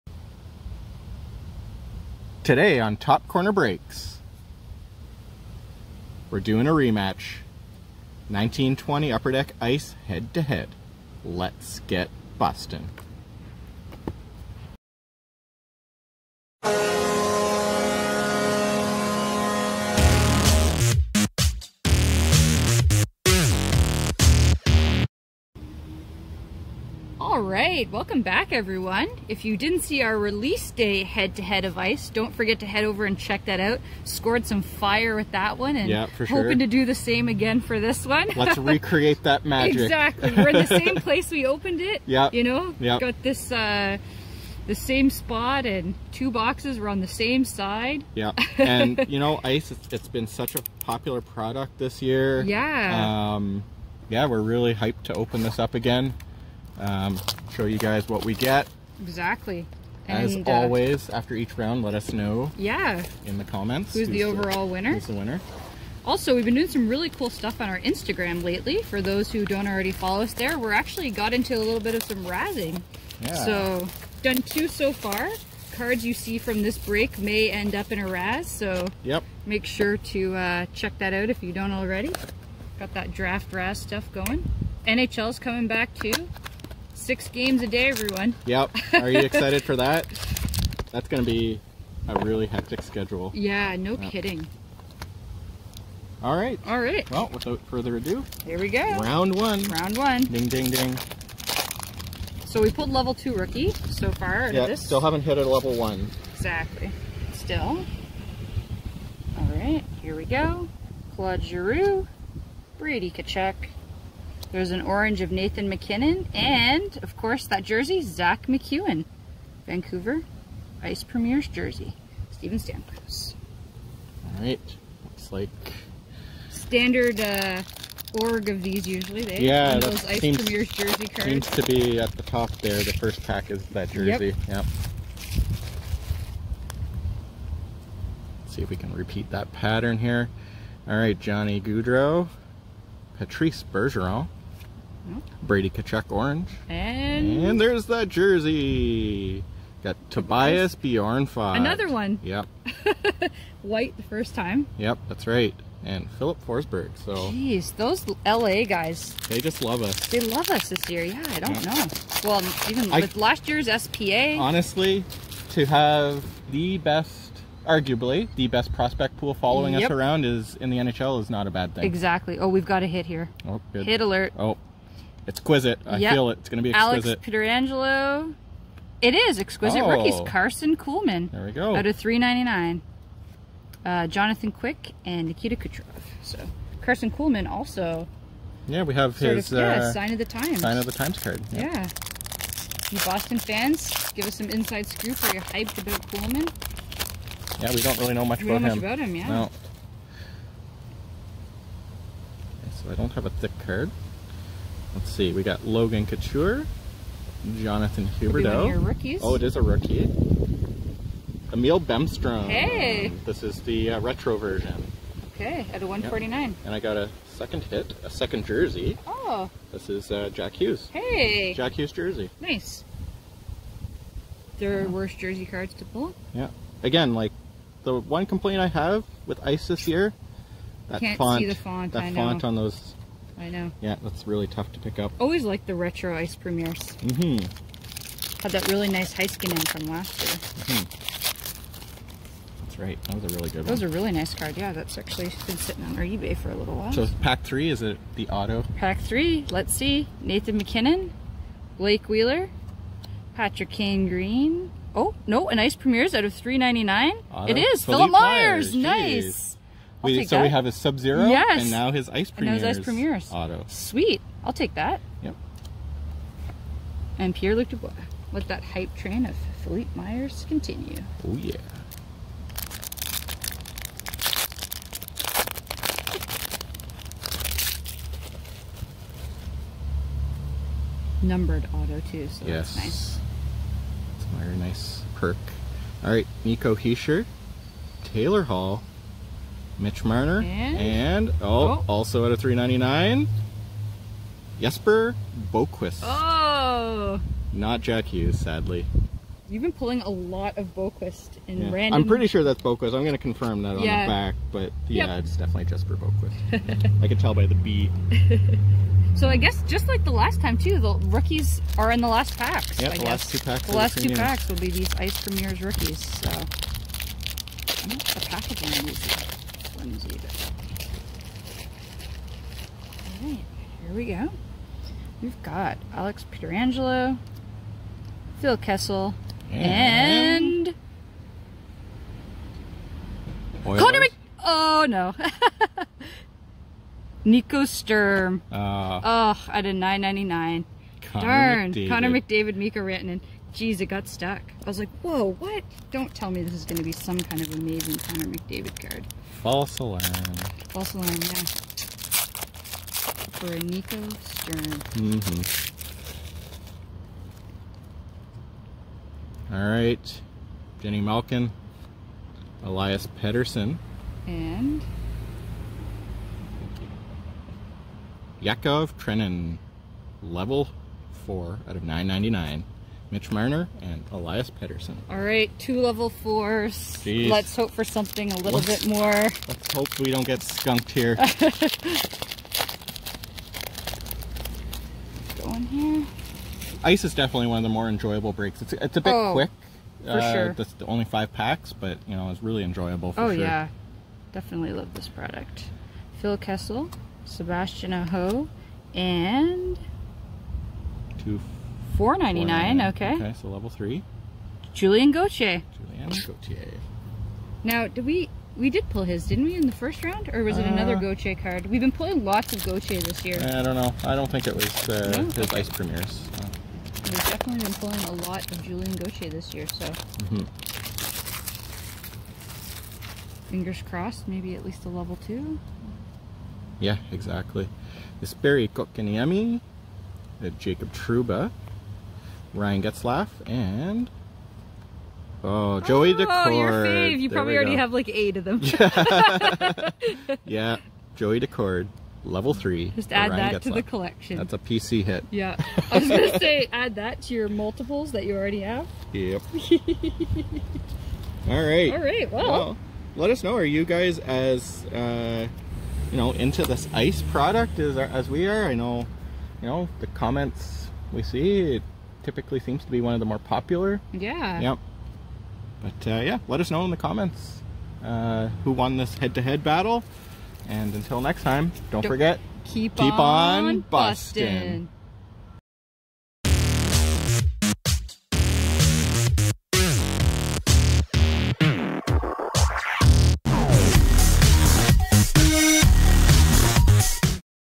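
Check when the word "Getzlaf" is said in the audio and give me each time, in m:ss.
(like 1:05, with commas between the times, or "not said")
7:12, 7:23.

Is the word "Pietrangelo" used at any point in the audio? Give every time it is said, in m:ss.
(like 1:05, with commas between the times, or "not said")
2:57, 5:26.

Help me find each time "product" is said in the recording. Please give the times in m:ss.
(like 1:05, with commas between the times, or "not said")
0:51, 6:35, 7:37.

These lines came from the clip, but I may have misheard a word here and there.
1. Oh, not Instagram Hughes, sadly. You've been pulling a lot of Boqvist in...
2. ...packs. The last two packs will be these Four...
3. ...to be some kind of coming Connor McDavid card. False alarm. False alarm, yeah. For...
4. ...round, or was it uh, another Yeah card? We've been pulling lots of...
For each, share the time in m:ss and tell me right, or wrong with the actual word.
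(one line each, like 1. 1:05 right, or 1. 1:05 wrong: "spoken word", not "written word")
1. 4:56 wrong: "Jack", not "Instagram"
2. 5:13 wrong: "Ice", not "Four"
3. 5:46 wrong: "amazing", not "coming"
4. 6:50 wrong: "Gauthier", not "Yeah".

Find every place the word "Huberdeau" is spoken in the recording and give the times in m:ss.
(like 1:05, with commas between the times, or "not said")
3:28.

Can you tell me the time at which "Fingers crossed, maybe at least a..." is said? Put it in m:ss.
7:03.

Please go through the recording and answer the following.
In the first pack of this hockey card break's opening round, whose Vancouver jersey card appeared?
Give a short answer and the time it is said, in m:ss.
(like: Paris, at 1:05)
Zack MacEwen, at 1:58.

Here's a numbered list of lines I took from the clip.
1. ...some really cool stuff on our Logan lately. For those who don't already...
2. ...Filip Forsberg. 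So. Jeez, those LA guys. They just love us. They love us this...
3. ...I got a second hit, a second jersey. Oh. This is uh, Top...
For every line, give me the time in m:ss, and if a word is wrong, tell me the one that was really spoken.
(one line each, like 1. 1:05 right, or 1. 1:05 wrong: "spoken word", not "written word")
1. 1:06 wrong: "Instagram", not "Logan"
2. 2:36 right
3. 3:36 wrong: "Jack", not "Top".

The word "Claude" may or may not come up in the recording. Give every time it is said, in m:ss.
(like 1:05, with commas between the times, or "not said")
1:51.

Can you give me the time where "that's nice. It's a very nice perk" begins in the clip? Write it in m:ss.
4:42.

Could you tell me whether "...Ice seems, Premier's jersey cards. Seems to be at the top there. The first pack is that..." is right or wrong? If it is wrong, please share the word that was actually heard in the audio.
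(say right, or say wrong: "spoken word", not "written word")
right.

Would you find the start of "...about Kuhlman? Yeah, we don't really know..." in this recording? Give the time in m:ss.
3:15.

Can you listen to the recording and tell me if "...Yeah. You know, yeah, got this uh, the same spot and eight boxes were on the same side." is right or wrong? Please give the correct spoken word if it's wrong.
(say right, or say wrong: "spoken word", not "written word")
wrong: "two", not "eight".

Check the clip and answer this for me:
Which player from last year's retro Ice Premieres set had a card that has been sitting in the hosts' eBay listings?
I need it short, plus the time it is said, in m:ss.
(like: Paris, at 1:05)
Heiskanen, at 3:59.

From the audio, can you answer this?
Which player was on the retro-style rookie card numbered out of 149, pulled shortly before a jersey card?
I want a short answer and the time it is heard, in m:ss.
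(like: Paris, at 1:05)
Emil Bemstrom, at 3:31.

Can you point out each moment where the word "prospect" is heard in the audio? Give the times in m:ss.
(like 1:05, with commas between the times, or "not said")
2:48.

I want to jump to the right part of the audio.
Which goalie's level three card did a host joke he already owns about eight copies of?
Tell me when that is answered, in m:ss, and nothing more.
7:21.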